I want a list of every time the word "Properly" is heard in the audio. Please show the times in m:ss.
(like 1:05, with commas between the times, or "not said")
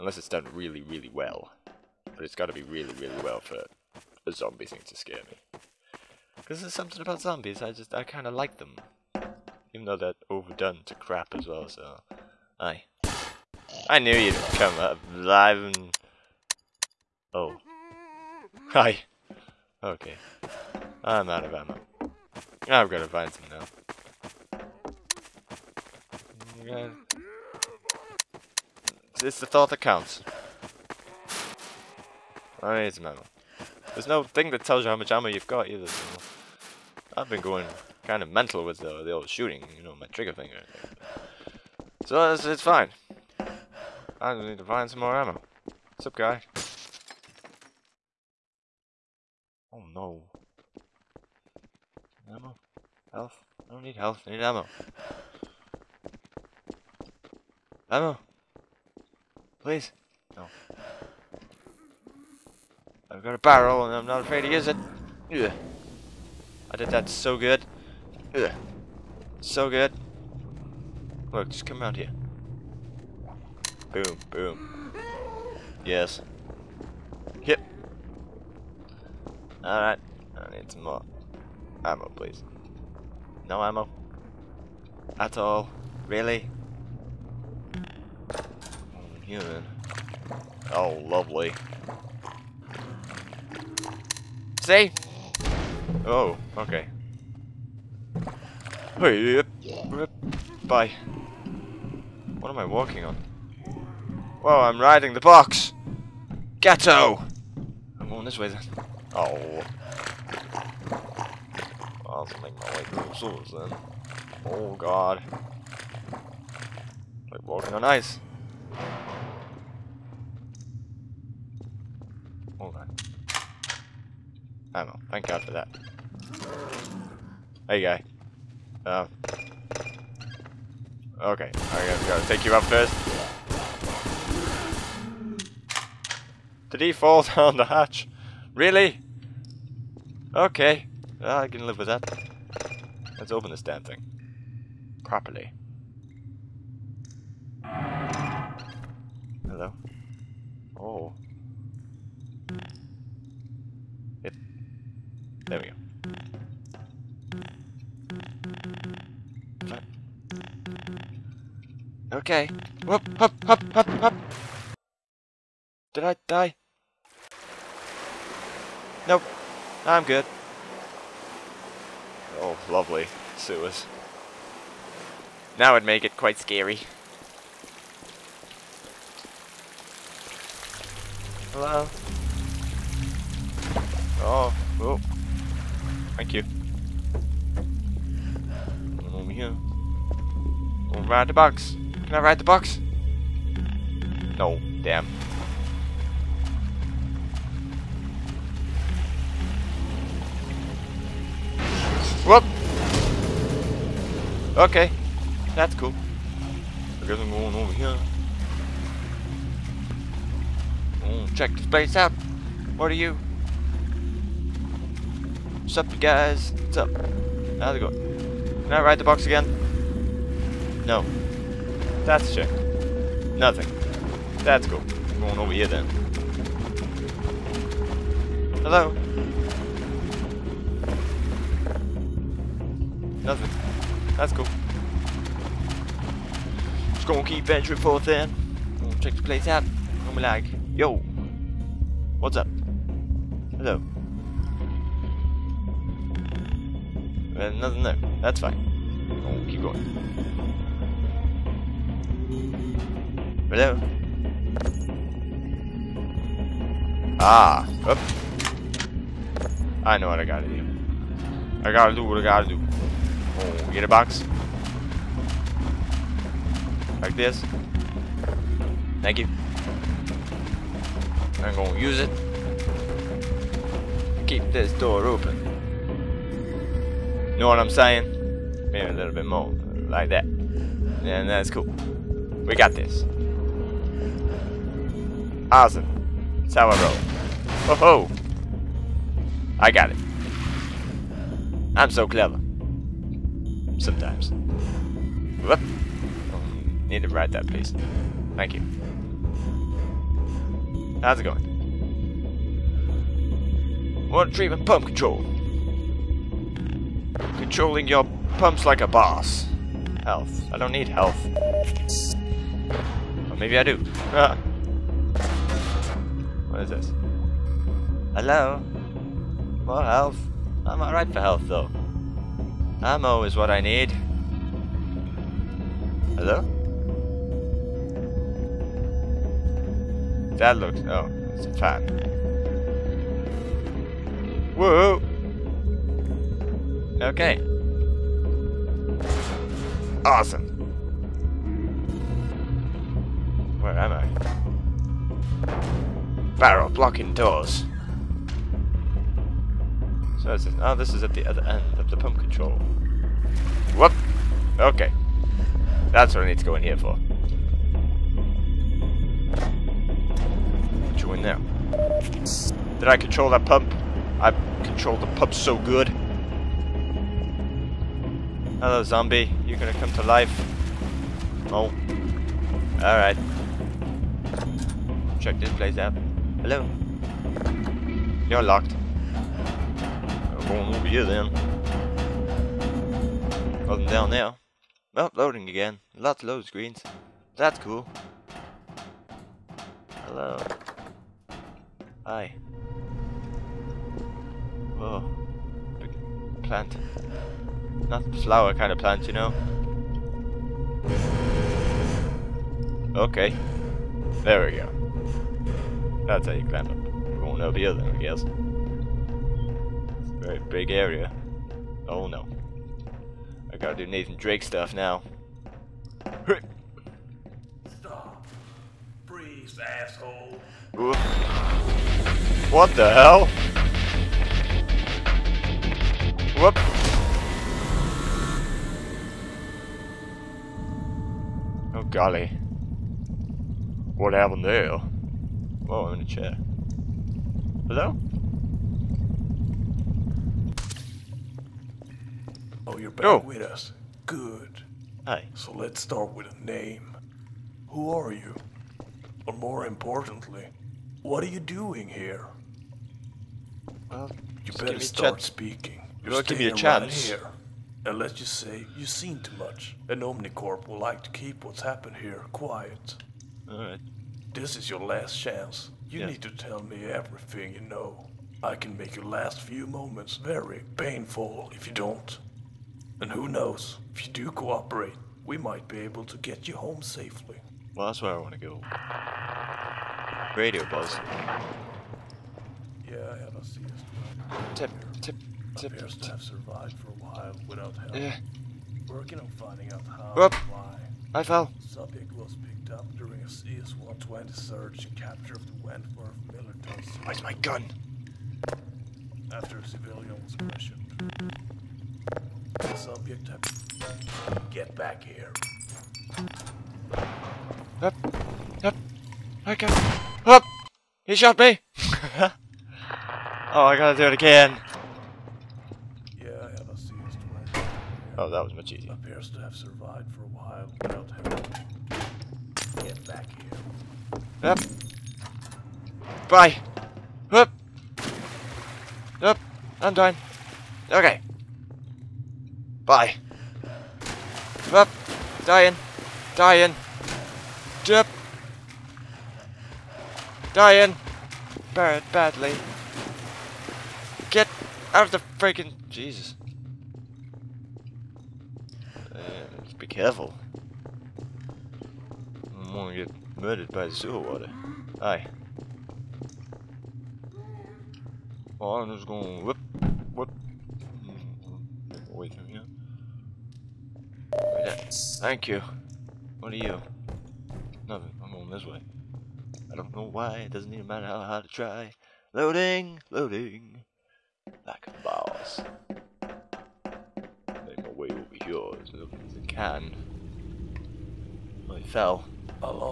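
2:25.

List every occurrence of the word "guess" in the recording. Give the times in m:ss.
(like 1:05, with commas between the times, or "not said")
3:27, 6:47.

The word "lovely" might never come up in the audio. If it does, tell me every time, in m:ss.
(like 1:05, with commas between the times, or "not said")
1:31, 2:52.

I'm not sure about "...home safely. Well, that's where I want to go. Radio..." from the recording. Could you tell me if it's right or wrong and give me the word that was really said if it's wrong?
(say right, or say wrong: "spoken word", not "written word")
right.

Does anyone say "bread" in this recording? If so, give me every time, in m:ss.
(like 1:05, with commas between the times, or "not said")
not said.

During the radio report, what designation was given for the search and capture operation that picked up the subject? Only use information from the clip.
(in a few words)
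CS-120.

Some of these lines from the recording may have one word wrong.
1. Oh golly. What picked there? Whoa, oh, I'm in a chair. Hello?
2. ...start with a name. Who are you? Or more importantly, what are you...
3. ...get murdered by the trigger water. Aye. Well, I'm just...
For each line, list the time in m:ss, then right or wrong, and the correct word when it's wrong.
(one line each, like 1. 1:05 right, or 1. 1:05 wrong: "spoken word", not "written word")
1. 7:11 wrong: "happened", not "picked"
2. 7:25 right
3. 9:13 wrong: "sewer", not "trigger".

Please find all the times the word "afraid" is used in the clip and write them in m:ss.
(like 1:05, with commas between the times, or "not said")
1:04.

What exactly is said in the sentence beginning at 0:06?
Because there's something about zombies, I just, I kind of like them.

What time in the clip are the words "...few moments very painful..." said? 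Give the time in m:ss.
7:49.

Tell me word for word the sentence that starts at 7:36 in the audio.
You're well, give me a chance.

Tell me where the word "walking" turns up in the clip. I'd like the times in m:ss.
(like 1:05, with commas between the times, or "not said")
1:42, 1:57.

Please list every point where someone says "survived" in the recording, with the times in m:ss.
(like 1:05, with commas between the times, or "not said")
8:06, 8:39.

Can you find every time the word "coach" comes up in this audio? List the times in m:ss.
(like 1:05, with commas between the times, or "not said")
not said.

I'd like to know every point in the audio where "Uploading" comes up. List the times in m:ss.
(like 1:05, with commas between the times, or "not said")
6:24.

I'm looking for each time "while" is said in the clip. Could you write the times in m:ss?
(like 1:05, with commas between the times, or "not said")
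8:07, 8:40.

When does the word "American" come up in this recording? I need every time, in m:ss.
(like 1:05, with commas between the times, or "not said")
not said.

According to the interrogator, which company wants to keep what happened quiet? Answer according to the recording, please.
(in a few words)
Omnicorp.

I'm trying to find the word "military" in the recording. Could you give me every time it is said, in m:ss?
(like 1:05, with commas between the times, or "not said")
8:16.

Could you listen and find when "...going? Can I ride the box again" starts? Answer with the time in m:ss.
3:37.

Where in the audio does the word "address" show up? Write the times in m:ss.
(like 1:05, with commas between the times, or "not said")
not said.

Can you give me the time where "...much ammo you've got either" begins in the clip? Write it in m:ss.
0:34.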